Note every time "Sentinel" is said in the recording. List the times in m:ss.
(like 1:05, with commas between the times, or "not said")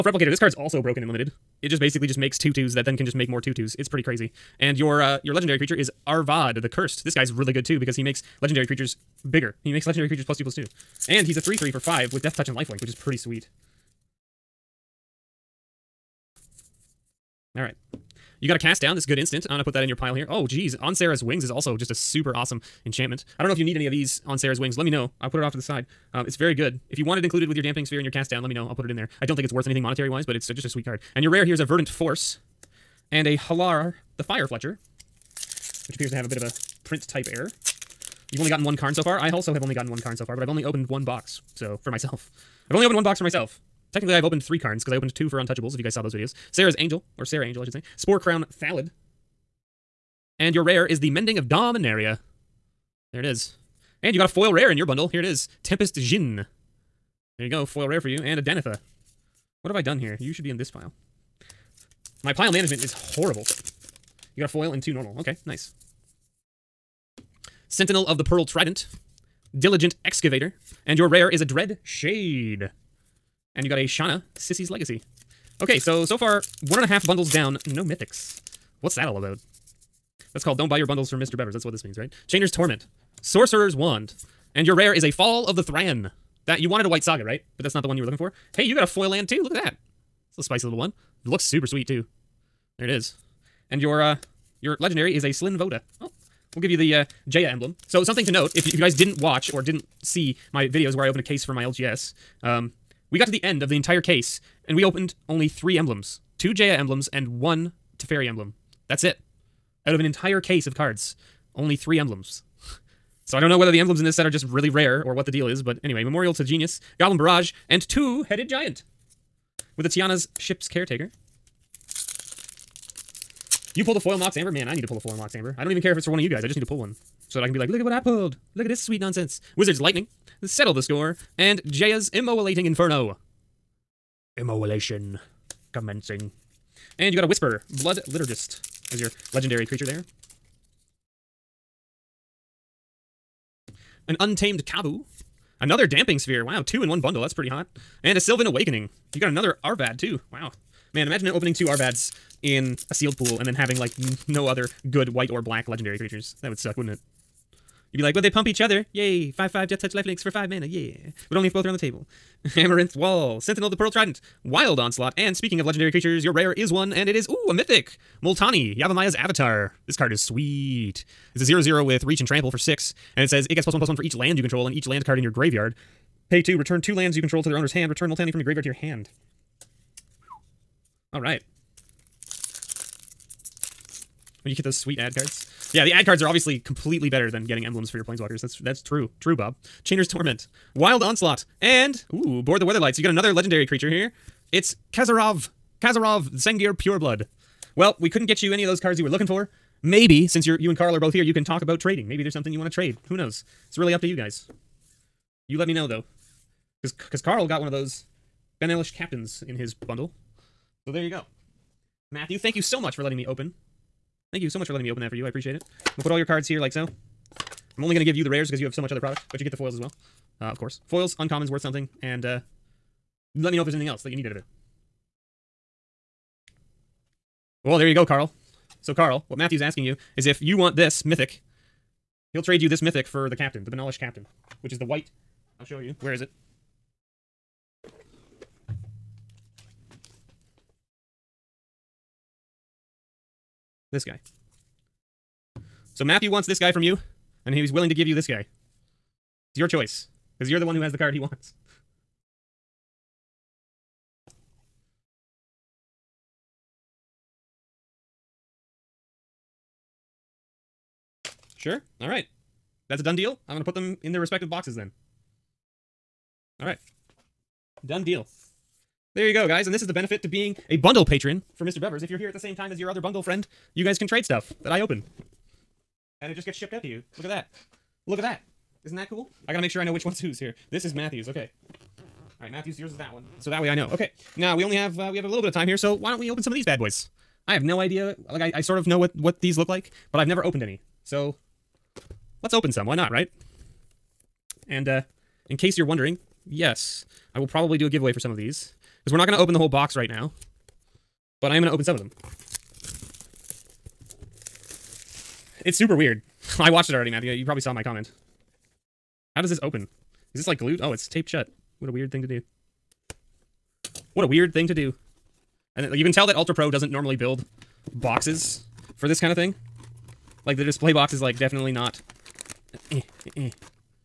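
1:07, 2:43.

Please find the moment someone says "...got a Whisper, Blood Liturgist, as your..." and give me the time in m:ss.
2:17.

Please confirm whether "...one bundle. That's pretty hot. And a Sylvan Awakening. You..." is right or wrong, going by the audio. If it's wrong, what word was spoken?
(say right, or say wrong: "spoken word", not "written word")
right.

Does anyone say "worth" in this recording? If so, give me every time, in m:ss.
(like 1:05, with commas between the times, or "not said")
0:29, 3:41.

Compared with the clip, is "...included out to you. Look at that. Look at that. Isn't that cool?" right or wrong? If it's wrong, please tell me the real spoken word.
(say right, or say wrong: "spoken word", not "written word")
wrong: "shipped", not "included".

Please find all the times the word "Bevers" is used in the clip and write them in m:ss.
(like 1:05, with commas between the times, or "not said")
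1:21, 4:31.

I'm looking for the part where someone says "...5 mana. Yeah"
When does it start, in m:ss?
2:40.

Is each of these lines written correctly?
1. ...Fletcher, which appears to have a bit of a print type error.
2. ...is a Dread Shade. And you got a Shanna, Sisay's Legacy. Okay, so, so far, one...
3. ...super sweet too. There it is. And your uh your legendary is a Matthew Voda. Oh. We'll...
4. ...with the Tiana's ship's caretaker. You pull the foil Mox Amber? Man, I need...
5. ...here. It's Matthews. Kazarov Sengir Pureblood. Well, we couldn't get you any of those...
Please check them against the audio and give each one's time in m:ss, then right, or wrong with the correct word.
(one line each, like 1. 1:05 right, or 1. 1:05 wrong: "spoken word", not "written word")
1. 0:34 right
2. 1:11 right
3. 1:31 wrong: "Slinn", not "Matthew"
4. 1:59 right
5. 3:13 wrong: "Kazarov", not "Matthews".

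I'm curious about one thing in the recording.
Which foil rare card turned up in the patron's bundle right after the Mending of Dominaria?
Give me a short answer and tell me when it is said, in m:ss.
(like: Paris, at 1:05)
Tempest Djinn, at 0:55.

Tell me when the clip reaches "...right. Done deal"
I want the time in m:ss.
4:26.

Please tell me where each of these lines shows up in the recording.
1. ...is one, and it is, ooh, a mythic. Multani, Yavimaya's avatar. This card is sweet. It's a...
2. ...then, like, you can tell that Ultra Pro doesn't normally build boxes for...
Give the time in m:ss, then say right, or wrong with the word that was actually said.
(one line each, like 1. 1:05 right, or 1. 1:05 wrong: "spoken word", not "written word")
1. 2:46 right
2. 5:15 right.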